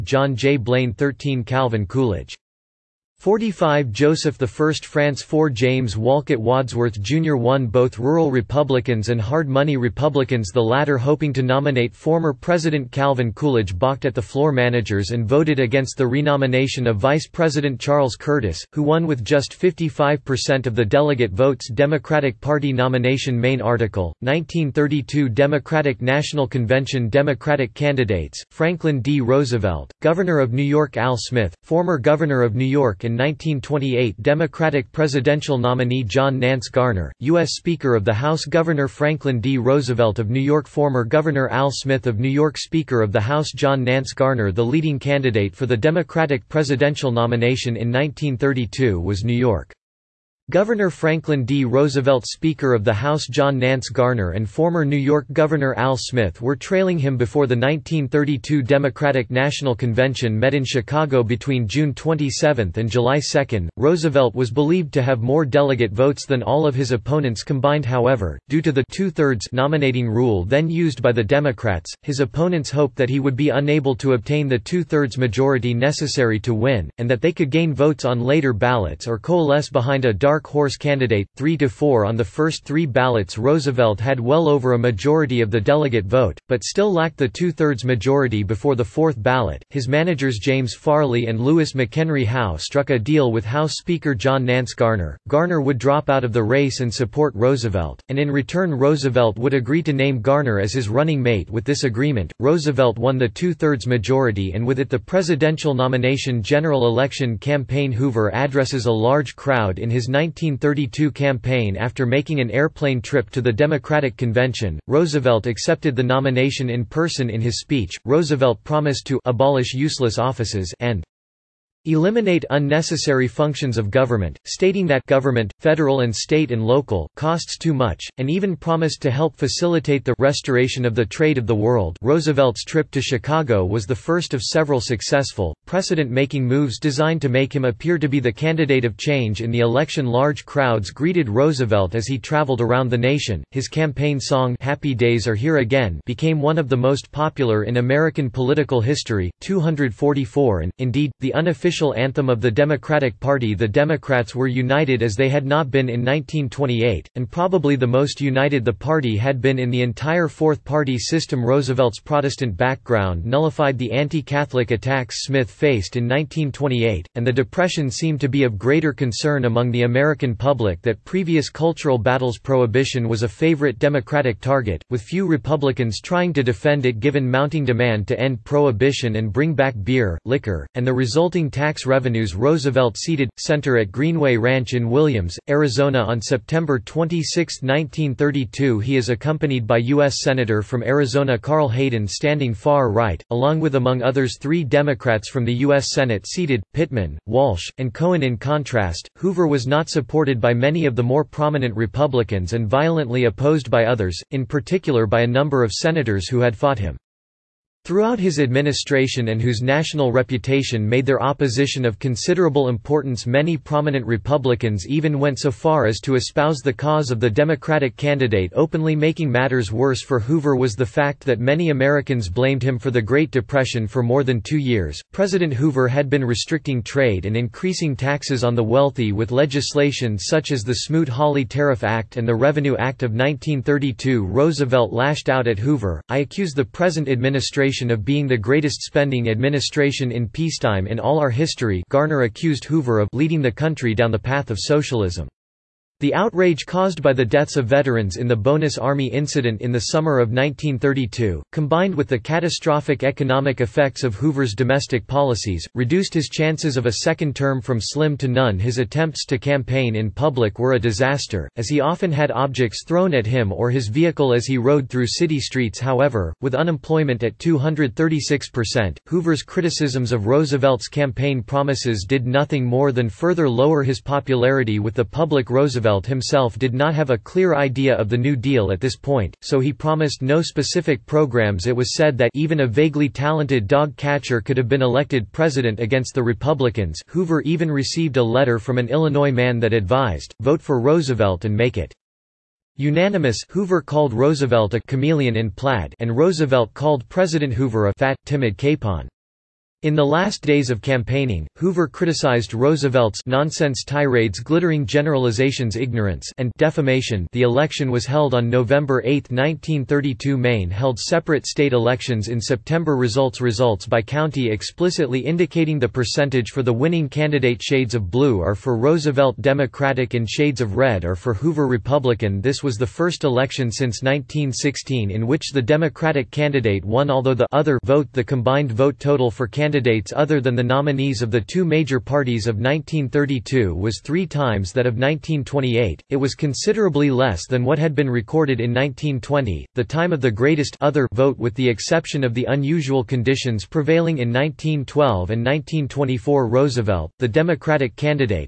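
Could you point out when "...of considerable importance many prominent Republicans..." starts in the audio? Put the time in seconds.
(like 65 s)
211 s.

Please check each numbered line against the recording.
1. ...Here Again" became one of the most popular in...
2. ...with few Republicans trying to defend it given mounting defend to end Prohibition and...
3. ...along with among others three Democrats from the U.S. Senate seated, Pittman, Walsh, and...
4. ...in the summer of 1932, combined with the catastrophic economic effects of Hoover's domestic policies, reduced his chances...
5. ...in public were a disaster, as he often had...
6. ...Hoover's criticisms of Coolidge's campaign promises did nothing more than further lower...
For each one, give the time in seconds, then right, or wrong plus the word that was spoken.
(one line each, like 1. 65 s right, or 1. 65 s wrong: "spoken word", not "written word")
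1. 145 s right
2. 174 s wrong: "demand", not "defend"
3. 193 s right
4. 249 s right
5. 259 s right
6. 269 s wrong: "Roosevelt", not "Coolidge".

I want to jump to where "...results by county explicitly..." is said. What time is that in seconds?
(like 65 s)
313 s.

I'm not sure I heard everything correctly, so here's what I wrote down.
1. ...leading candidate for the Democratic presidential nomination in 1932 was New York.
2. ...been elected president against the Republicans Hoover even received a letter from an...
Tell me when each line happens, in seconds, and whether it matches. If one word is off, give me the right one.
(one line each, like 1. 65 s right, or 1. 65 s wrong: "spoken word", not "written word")
1. 44 s right
2. 284 s right.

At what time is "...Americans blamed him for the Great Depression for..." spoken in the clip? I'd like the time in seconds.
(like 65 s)
221 s.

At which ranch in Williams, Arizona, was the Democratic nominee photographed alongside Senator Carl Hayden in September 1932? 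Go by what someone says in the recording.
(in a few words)
Greenway Ranch.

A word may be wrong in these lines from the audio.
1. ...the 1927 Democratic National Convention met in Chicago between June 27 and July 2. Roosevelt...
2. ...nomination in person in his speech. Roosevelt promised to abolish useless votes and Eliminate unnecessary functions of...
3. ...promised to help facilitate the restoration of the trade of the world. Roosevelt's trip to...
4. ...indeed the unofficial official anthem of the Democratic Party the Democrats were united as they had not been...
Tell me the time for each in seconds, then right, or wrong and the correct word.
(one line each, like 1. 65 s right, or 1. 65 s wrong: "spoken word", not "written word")
1. 57 s wrong: "1932", not "1927"
2. 116 s wrong: "offices", not "votes"
3. 128 s right
4. 150 s right.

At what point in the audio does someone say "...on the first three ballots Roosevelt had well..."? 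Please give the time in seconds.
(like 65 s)
82 s.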